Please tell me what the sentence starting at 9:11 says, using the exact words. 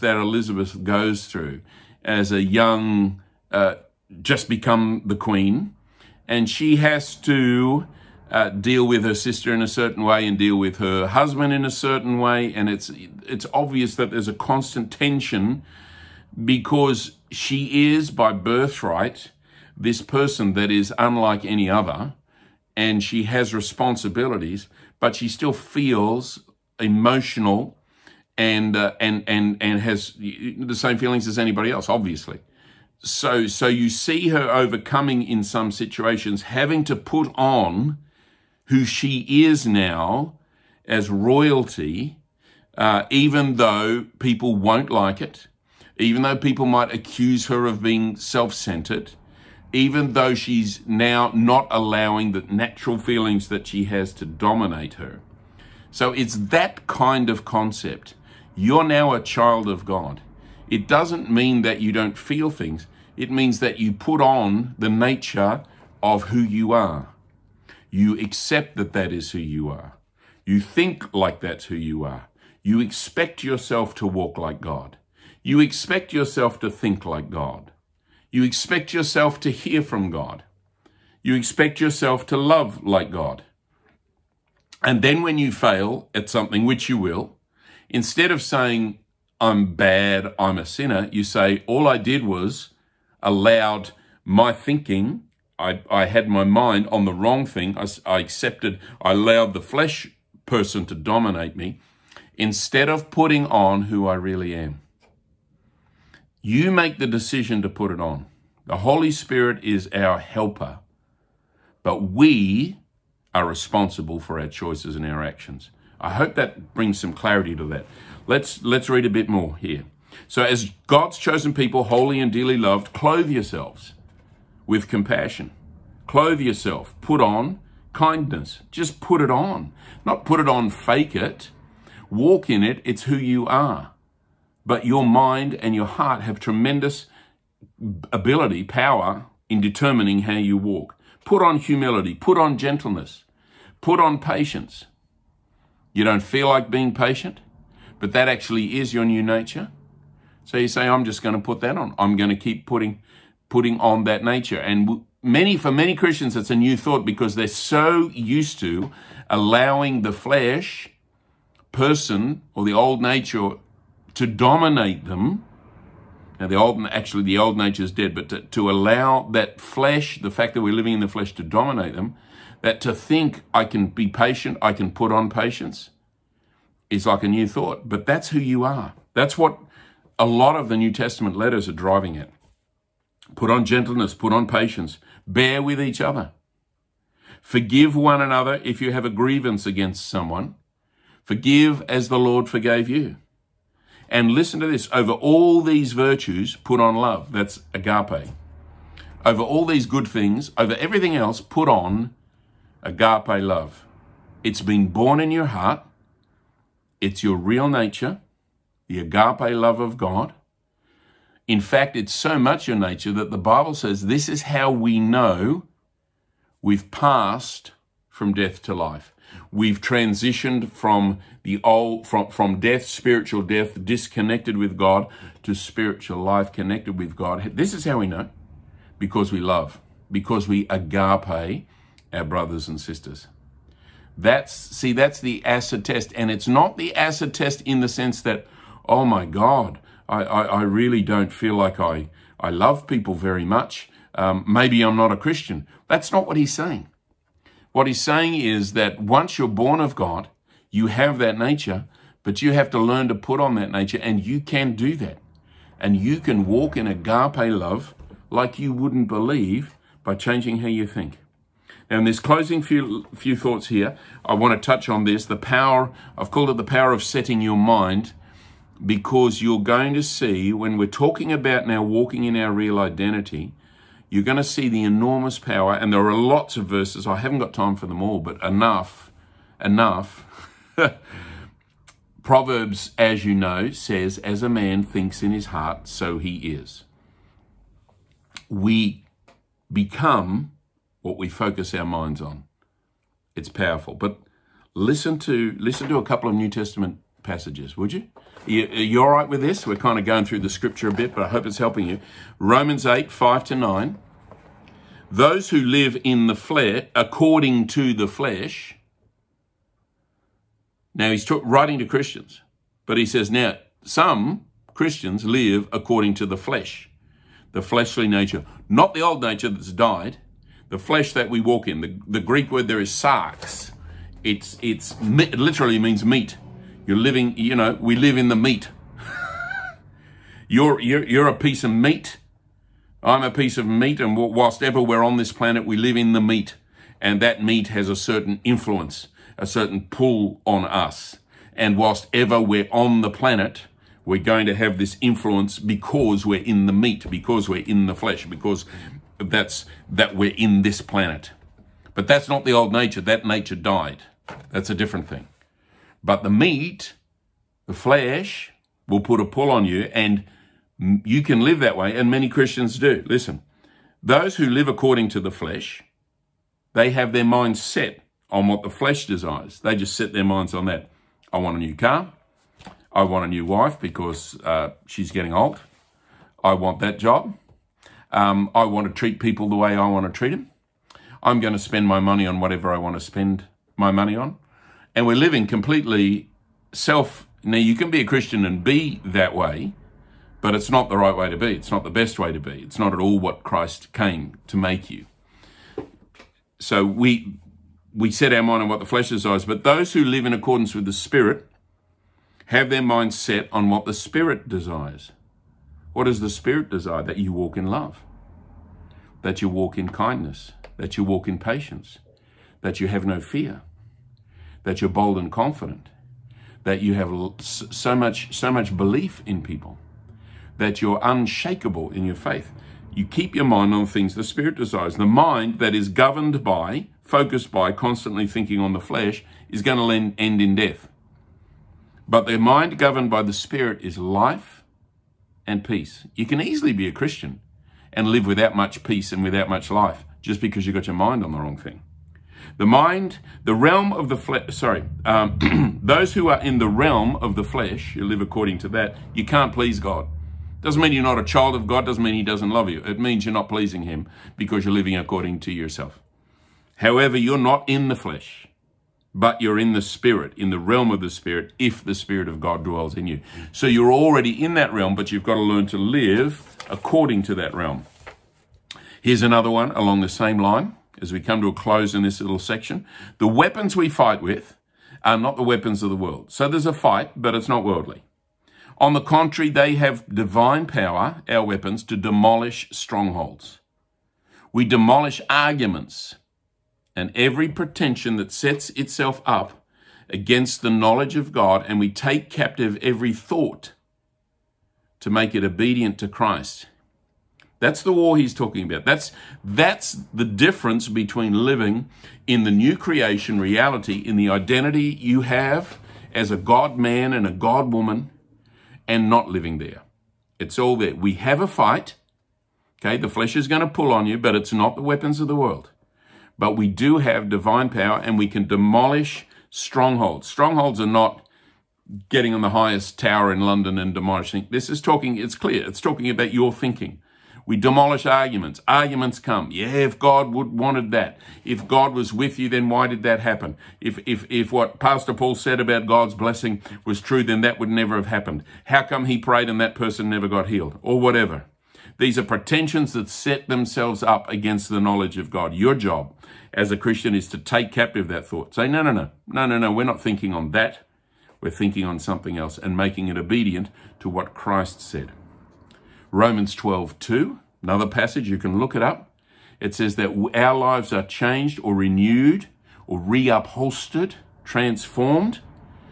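We're thinking on something else and making it obedient to what Christ said.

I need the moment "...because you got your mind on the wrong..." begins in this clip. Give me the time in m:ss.
7:20.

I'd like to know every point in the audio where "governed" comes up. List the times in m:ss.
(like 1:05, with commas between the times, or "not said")
7:05, 7:12.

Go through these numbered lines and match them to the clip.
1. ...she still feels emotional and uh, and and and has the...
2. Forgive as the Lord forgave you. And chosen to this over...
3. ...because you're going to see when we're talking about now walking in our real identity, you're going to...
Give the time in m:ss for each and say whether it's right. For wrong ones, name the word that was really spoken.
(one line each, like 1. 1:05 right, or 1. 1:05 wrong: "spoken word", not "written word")
1. 0:25 right
2. 3:11 wrong: "listen", not "chosen"
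3. 4:28 right.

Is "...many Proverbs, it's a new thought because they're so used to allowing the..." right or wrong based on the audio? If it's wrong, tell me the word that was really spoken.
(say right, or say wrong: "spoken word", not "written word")
wrong: "Christians", not "Proverbs".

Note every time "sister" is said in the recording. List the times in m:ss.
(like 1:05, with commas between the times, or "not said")
0:09, 3:52.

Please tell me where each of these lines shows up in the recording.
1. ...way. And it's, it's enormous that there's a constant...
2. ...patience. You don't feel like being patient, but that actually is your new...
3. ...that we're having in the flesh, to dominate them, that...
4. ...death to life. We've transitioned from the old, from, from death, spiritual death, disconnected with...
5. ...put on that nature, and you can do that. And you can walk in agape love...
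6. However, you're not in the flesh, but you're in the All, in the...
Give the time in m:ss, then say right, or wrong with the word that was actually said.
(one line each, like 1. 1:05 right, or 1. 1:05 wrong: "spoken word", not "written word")
1. 0:12 wrong: "obvious", not "enormous"
2. 2:24 right
3. 2:50 wrong: "living", not "having"
4. 3:38 right
5. 4:13 right
6. 7:36 wrong: "Spirit", not "All".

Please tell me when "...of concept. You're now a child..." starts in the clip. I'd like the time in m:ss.
0:57.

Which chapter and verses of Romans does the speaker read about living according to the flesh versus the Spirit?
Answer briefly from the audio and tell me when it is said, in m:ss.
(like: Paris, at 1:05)
Romans 8:5-9, at 5:02.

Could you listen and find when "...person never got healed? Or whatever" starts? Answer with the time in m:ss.
8:59.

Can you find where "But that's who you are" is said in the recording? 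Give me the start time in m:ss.
2:57.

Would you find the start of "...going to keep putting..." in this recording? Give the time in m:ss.
2:32.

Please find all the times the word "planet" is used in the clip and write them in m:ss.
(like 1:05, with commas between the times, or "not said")
5:35, 5:43, 5:50.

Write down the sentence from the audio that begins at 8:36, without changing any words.
But we do have divine power and we can demolish strongholds.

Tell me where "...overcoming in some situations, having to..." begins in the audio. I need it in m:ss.
0:34.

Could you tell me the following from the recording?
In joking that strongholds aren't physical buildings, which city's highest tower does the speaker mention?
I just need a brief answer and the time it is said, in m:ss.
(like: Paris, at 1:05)
London, at 8:43.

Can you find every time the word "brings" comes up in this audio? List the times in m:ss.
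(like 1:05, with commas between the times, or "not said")
1:56.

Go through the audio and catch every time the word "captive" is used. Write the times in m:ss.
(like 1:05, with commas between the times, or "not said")
8:12, 9:07.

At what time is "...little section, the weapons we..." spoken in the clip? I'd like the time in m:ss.
7:52.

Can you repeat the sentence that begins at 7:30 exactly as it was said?
Doesn't mean you're not a child of God, doesn't mean He doesn't love you.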